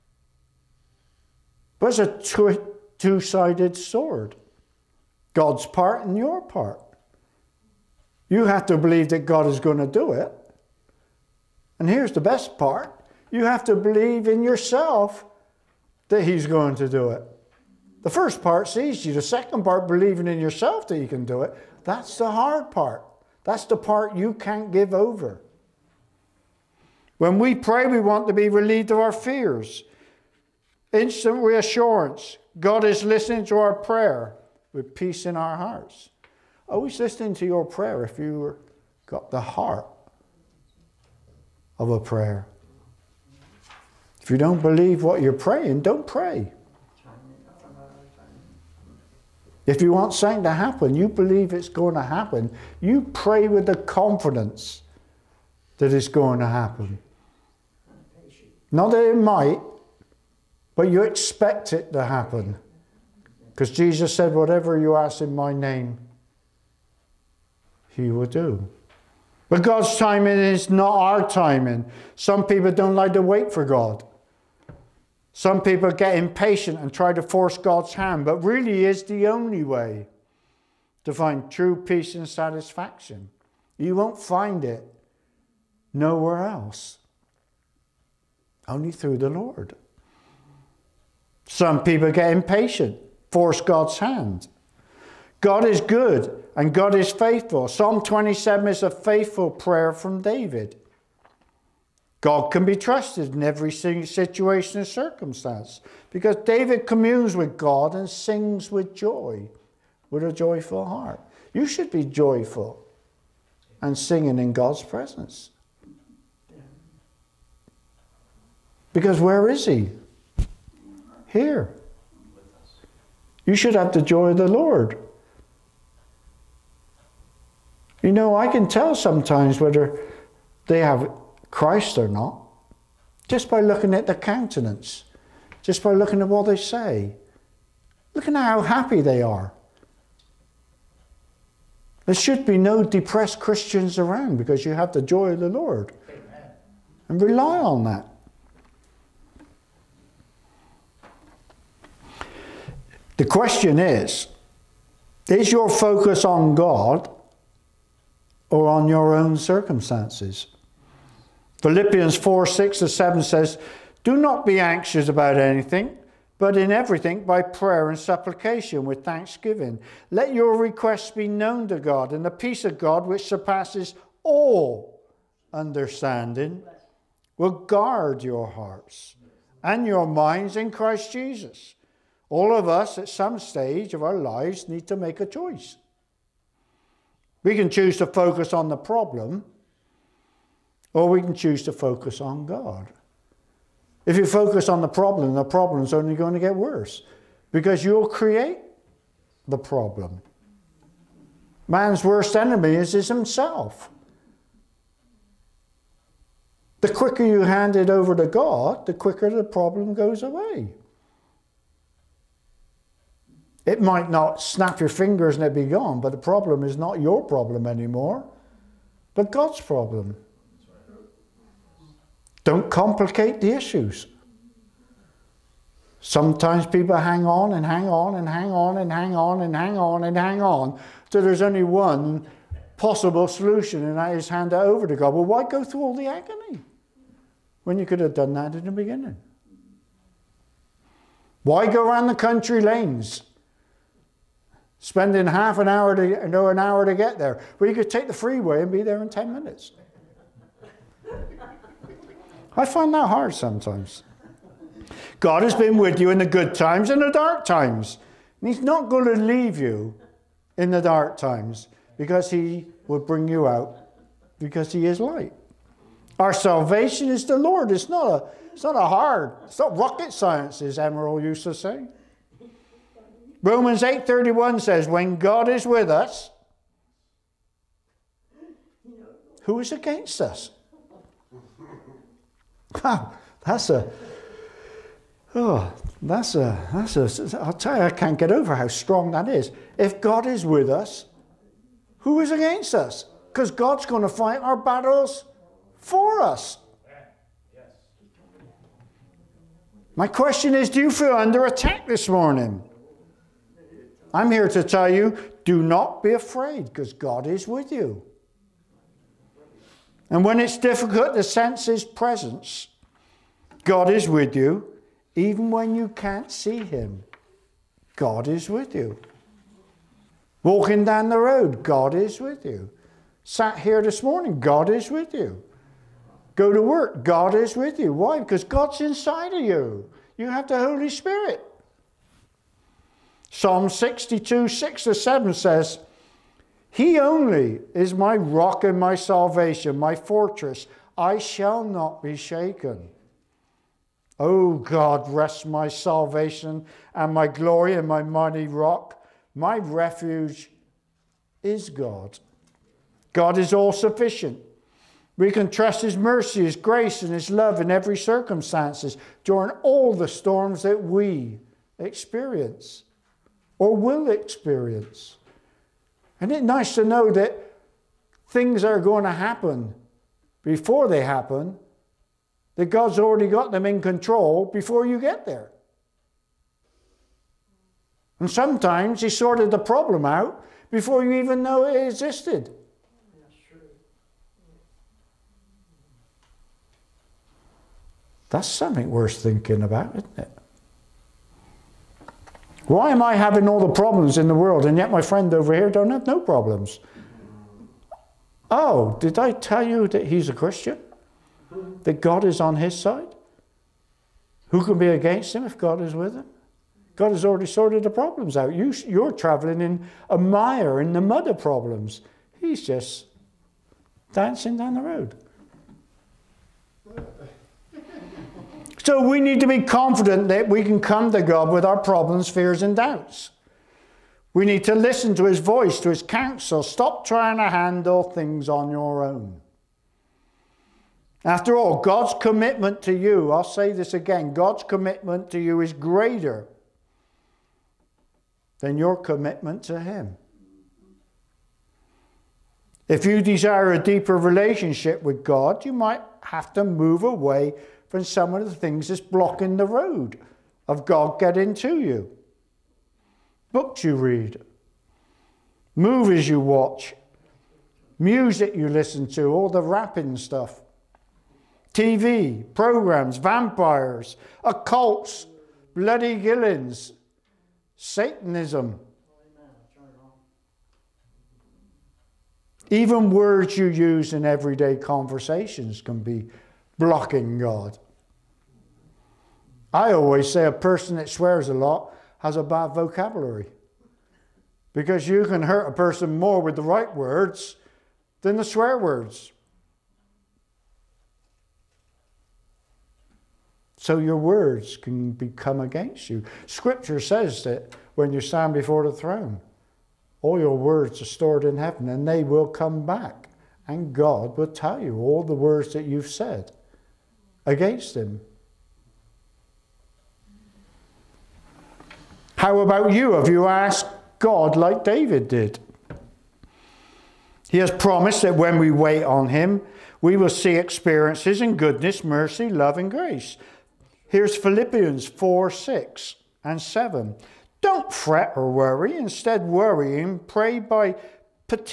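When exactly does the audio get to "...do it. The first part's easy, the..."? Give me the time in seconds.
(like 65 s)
16 s.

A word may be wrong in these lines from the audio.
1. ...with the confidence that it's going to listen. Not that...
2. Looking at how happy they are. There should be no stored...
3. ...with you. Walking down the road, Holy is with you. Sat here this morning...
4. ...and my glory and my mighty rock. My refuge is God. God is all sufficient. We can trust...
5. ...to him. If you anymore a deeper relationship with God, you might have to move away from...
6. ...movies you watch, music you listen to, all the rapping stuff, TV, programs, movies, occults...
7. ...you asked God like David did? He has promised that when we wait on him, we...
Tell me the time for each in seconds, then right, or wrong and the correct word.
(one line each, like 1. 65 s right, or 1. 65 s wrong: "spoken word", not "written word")
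1. 53 s wrong: "happen", not "listen"
2. 138 s wrong: "depressed", not "stored"
3. 318 s wrong: "God", not "Holy"
4. 346 s right
5. 439 s wrong: "desire", not "anymore"
6. 455 s wrong: "vampires", not "movies"
7. 513 s right.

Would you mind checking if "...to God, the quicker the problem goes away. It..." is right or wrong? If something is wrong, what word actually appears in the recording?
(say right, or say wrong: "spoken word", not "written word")
right.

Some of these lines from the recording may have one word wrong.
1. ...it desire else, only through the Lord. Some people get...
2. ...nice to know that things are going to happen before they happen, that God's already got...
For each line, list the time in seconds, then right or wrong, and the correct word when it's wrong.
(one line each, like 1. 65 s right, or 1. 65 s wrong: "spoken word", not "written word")
1. 84 s wrong: "nowhere", not "desire"
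2. 366 s right.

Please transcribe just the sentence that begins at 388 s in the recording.
That's something worth thinking about, isn't it?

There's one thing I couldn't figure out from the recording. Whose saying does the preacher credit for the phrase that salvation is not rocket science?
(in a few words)
Emerald.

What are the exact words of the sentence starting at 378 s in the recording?
And sometimes He sorted the problem out before you even know it existed.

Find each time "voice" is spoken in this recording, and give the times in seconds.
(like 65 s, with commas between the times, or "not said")
425 s.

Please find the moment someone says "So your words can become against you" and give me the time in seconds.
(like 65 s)
493 s.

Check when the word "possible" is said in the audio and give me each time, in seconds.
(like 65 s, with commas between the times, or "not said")
232 s.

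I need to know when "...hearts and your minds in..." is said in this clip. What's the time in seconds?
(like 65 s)
178 s.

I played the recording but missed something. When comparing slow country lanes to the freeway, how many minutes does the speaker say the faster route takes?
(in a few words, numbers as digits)
10.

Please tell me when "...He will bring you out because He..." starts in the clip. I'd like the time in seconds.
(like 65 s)
262 s.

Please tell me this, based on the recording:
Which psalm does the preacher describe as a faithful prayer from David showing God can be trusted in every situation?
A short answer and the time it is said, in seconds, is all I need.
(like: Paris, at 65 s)
Psalm 27, at 97 s.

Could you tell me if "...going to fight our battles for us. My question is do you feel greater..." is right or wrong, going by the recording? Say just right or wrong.
wrong.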